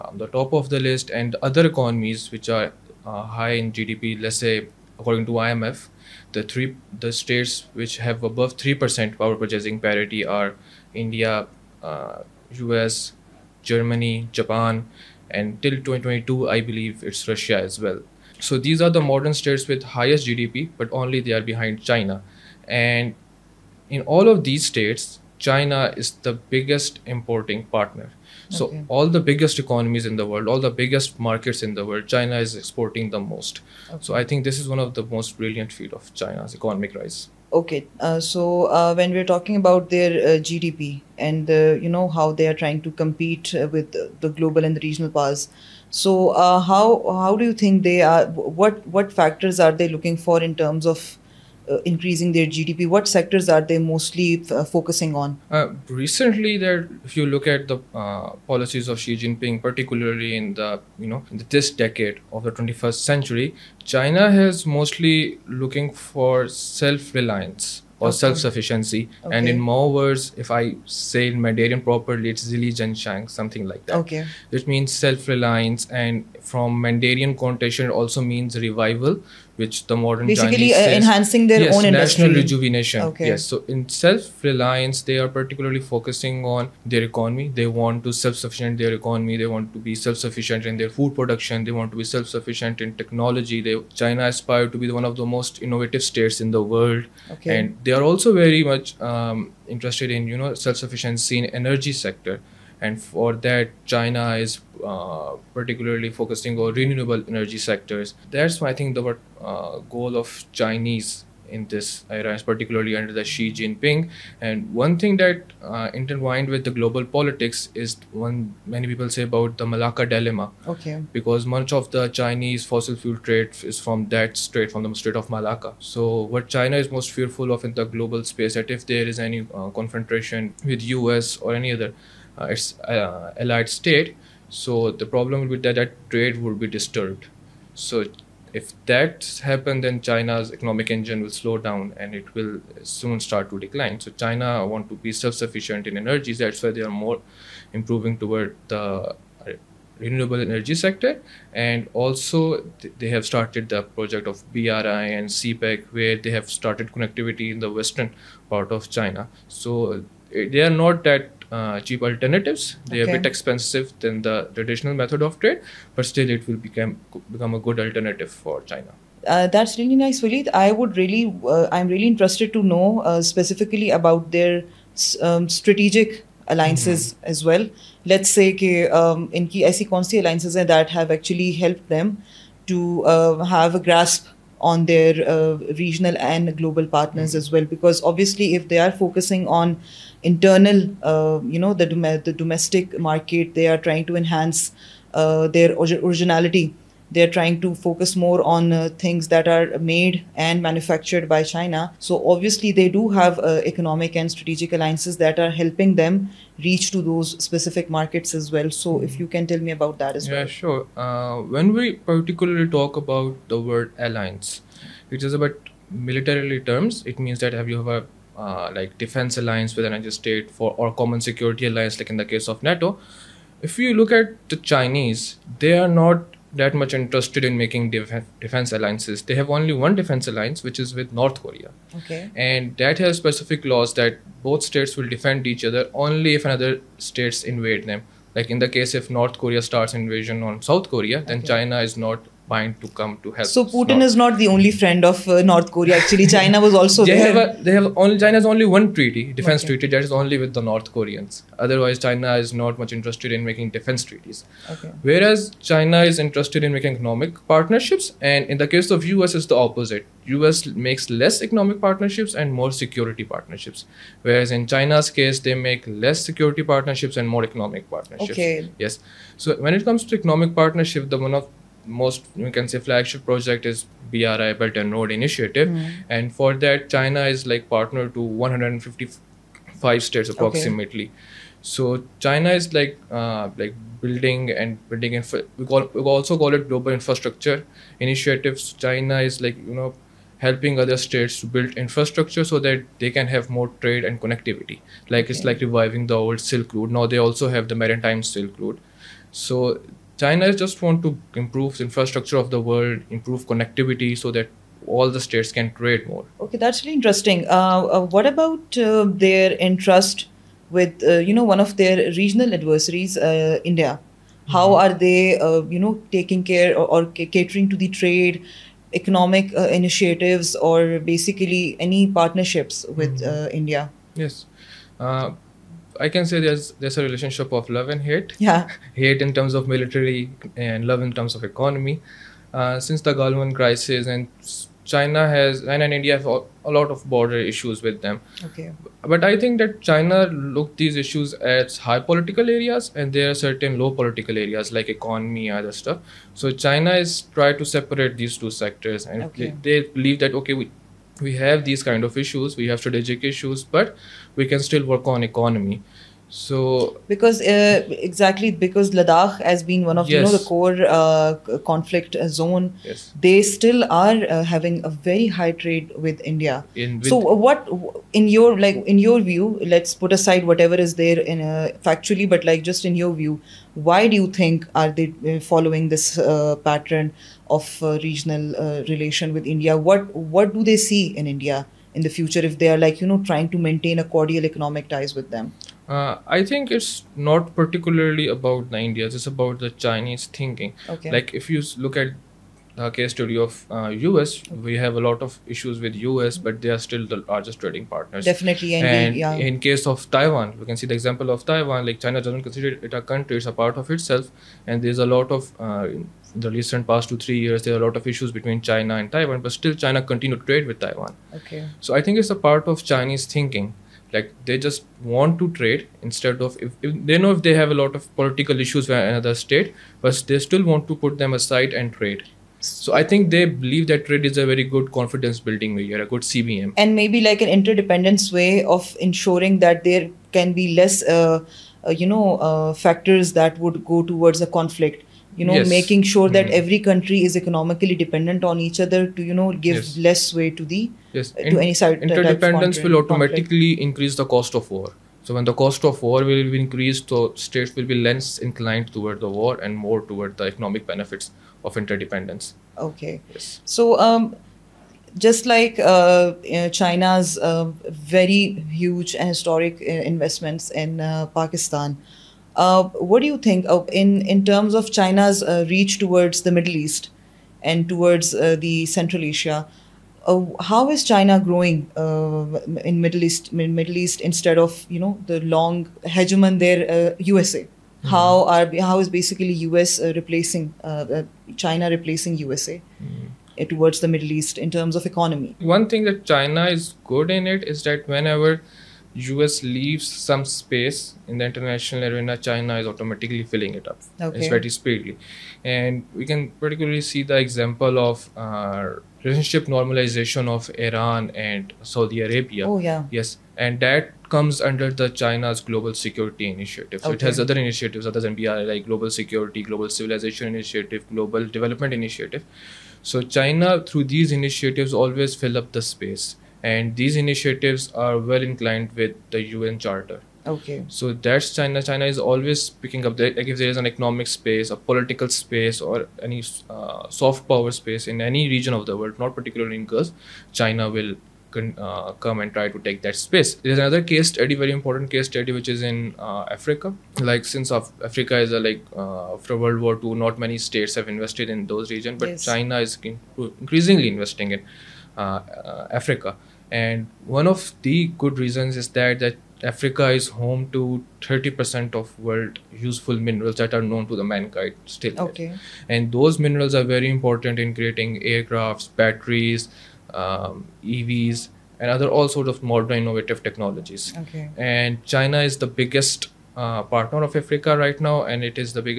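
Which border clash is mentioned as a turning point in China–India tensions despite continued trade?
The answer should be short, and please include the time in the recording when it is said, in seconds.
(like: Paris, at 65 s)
Galwan crisis, at 333 s.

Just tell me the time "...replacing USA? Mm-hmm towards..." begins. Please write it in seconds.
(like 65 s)
481 s.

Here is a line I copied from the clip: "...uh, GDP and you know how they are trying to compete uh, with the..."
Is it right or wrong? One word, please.
right.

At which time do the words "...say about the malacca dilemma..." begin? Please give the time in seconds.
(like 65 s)
119 s.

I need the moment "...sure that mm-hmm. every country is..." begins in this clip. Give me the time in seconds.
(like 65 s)
436 s.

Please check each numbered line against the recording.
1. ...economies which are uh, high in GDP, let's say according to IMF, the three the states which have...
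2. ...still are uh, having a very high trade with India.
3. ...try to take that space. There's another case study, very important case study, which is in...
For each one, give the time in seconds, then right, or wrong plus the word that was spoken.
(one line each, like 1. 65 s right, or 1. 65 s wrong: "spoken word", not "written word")
1. 1 s right
2. 363 s right
3. 532 s right.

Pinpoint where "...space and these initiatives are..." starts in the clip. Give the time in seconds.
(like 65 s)
515 s.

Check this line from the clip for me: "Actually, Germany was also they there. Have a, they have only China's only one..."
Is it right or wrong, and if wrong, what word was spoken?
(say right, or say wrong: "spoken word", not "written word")
wrong: "China", not "Germany".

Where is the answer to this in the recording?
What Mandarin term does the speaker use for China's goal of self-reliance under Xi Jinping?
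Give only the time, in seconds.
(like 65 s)
72 s.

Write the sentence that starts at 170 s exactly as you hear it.
I would really, uh, I'm really interested to know uh, specifically about their um, strategic alliances mm-hmm.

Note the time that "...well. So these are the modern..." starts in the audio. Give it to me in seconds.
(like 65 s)
17 s.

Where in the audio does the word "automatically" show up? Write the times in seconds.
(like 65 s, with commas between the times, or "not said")
442 s, 492 s.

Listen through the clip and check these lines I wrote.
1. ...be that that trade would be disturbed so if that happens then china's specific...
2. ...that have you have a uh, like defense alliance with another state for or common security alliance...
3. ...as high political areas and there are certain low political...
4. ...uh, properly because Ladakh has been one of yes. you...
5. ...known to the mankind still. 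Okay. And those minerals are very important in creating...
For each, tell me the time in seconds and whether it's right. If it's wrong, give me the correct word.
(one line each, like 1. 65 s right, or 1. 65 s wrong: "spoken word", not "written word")
1. 135 s wrong: "economic", not "specific"
2. 217 s right
3. 341 s right
4. 357 s wrong: "exactly", not "properly"
5. 553 s right.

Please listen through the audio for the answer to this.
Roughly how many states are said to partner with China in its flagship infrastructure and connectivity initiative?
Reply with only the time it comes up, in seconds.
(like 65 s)
278 s.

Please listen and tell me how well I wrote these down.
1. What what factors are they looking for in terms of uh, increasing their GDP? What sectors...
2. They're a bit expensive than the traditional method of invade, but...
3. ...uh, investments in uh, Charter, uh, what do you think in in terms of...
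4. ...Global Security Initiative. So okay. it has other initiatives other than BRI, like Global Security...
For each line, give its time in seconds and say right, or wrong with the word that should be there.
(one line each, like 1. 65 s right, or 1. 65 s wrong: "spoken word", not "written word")
1. 48 s right
2. 162 s wrong: "trade", not "invade"
3. 459 s wrong: "Pakistan", not "Charter"
4. 505 s right.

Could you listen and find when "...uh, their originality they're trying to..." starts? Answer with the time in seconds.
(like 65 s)
195 s.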